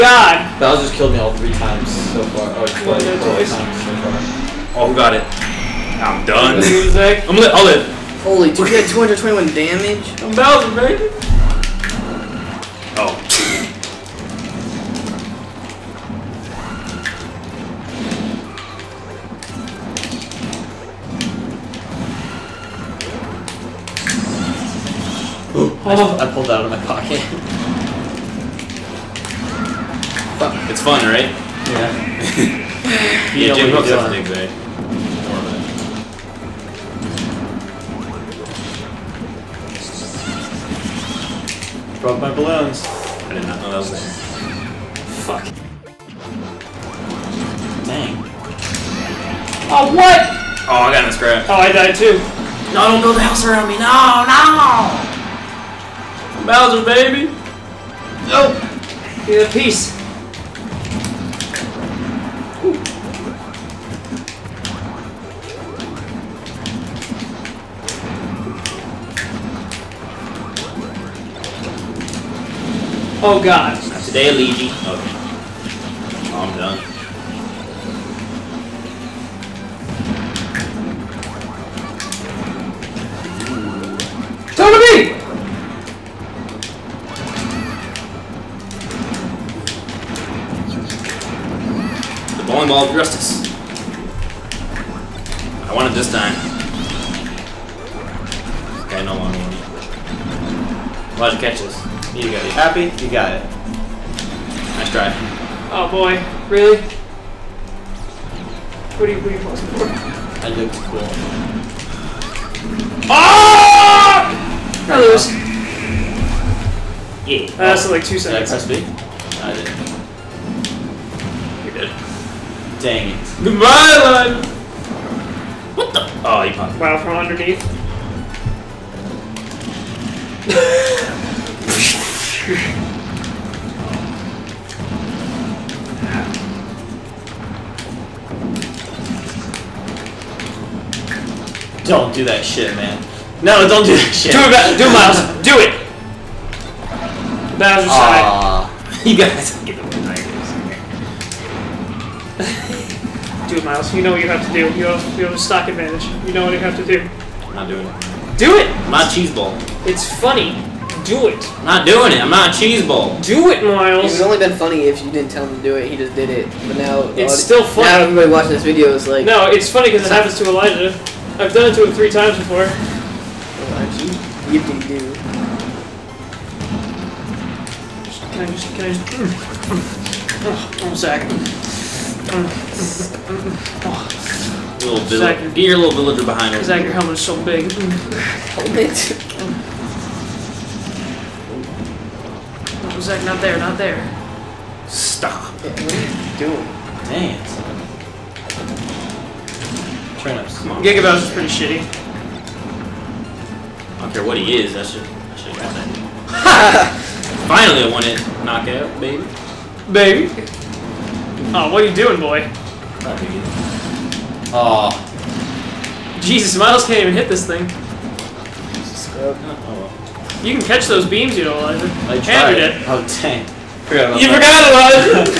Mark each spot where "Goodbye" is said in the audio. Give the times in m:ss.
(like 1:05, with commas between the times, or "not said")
2:03.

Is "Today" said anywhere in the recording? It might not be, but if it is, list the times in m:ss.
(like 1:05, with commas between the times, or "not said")
1:14.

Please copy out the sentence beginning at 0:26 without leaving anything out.
I, pulled that out of my pocket.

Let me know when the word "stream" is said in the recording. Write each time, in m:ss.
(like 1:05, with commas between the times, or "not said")
not said.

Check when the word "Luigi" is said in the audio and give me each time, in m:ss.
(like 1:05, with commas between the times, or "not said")
1:14.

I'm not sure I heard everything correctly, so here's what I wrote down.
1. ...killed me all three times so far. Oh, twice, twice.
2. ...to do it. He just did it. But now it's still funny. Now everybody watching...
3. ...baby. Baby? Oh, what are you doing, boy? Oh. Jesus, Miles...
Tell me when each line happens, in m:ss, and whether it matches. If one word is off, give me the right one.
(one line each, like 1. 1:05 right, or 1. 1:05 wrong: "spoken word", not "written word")
1. 0:00 right
2. 2:45 right
3. 3:28 right.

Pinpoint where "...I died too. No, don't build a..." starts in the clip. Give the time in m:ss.
0:51.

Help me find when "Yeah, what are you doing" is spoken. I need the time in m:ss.
3:15.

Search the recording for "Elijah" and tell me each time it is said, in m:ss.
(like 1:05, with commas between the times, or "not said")
2:50, 3:41.